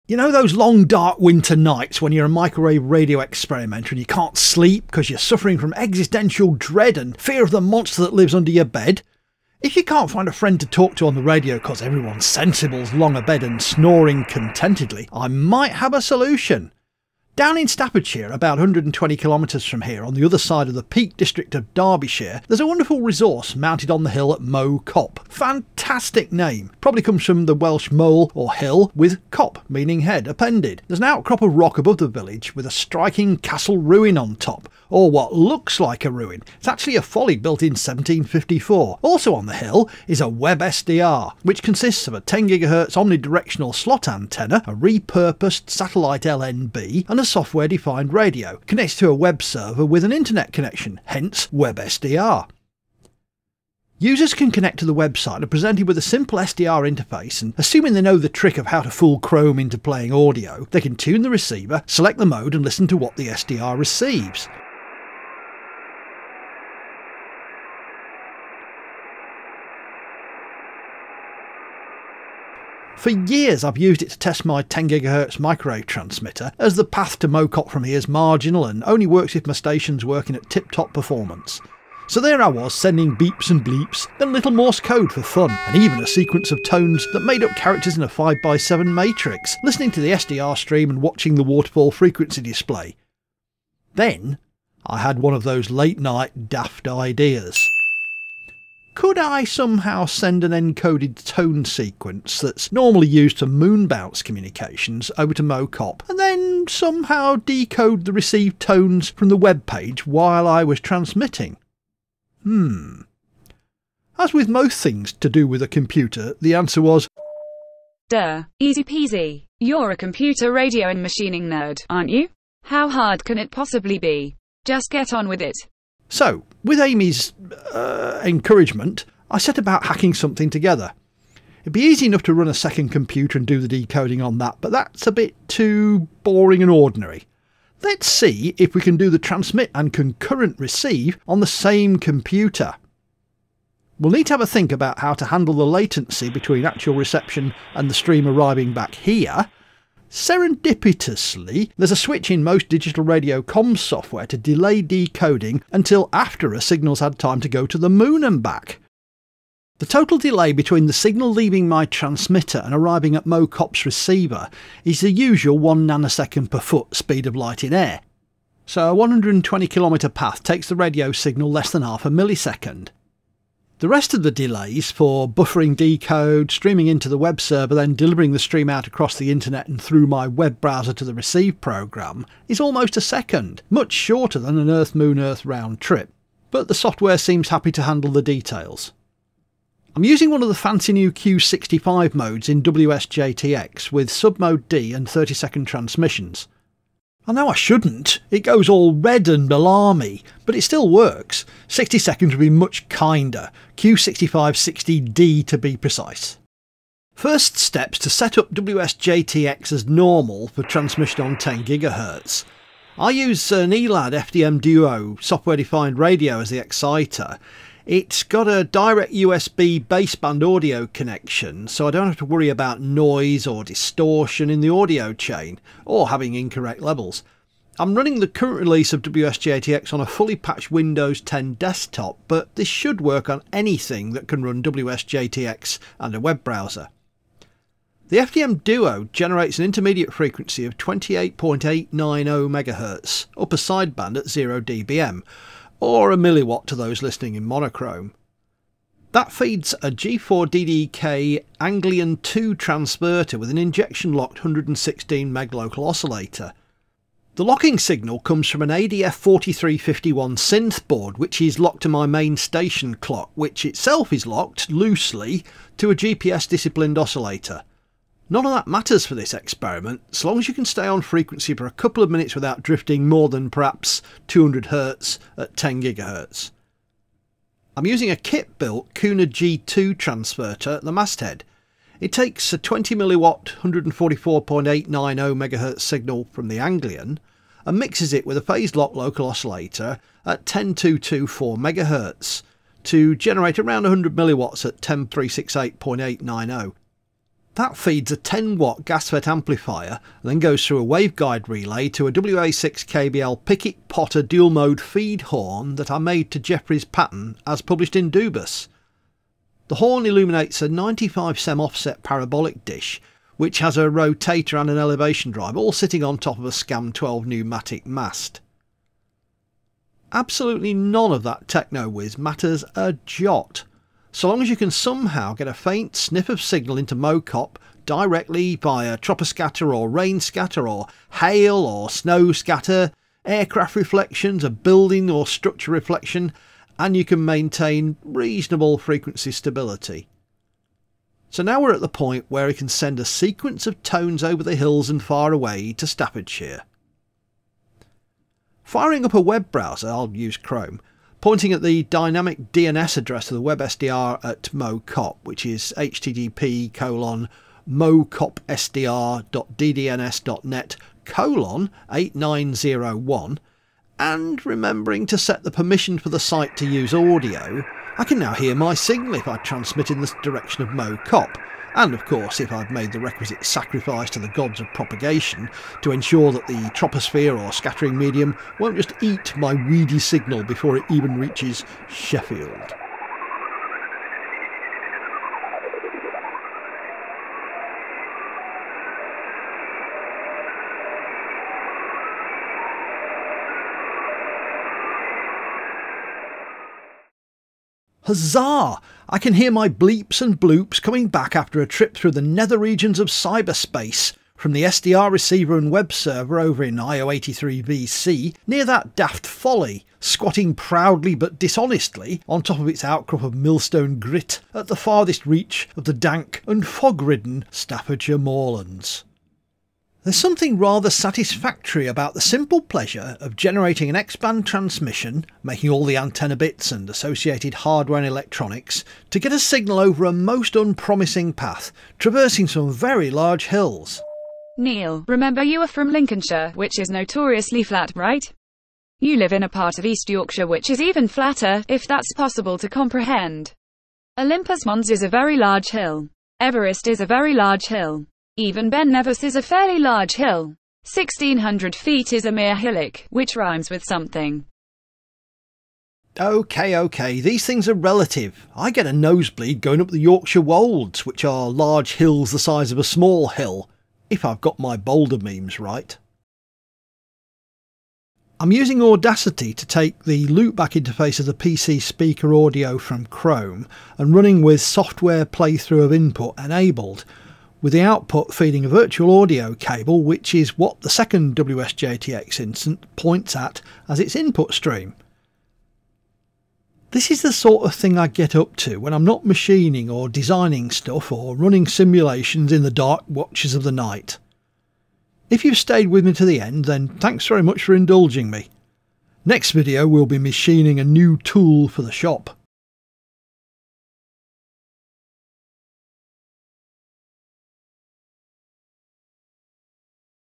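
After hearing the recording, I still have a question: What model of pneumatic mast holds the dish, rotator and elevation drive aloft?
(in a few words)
SCAM 12.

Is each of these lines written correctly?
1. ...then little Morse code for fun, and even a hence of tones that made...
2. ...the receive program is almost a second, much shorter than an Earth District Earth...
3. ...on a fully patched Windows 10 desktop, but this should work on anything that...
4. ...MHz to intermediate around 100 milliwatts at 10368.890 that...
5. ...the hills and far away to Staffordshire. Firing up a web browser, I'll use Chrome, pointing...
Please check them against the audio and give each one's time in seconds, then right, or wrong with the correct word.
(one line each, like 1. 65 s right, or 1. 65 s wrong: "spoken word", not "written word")
1. 84 s wrong: "sequence", not "hence"
2. 181 s wrong: "Moon", not "District"
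3. 229 s right
4. 291 s wrong: "generate", not "intermediate"
5. 344 s right.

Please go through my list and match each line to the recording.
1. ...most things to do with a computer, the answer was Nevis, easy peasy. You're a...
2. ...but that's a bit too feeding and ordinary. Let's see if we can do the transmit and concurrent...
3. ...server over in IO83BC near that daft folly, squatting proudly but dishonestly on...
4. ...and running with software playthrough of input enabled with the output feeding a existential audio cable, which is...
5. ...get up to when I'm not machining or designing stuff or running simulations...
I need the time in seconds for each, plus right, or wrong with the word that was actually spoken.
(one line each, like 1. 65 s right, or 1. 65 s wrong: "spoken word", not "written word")
1. 114 s wrong: "Duh", not "Nevis"
2. 134 s wrong: "boring", not "feeding"
3. 405 s right
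4. 473 s wrong: "virtual", not "existential"
5. 488 s right.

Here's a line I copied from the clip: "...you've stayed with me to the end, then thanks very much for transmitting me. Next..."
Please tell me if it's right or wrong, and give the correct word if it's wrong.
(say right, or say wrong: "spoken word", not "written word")
wrong: "indulging", not "transmitting".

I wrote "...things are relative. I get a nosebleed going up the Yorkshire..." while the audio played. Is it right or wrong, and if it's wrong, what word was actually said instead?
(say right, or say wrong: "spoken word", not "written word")
right.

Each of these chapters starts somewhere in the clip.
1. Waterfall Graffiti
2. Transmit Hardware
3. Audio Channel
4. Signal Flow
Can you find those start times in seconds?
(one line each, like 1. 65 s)
1. 75 s
2. 237 s
3. 340 s
4. 468 s.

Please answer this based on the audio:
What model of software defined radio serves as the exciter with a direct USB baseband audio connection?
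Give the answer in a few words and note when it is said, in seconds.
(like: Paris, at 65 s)
ELAD FDM Duo, at 213 s.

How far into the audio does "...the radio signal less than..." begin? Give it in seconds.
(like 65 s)
170 s.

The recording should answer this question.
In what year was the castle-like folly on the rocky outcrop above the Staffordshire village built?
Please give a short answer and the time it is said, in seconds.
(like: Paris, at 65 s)
1754, at 37 s.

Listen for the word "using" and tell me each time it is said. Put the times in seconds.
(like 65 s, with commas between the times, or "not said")
190 s, 277 s, 468 s.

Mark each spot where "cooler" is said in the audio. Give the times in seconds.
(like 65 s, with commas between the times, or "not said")
not said.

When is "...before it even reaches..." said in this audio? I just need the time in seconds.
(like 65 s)
380 s.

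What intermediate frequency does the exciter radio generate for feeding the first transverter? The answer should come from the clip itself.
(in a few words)
28.890 MHz.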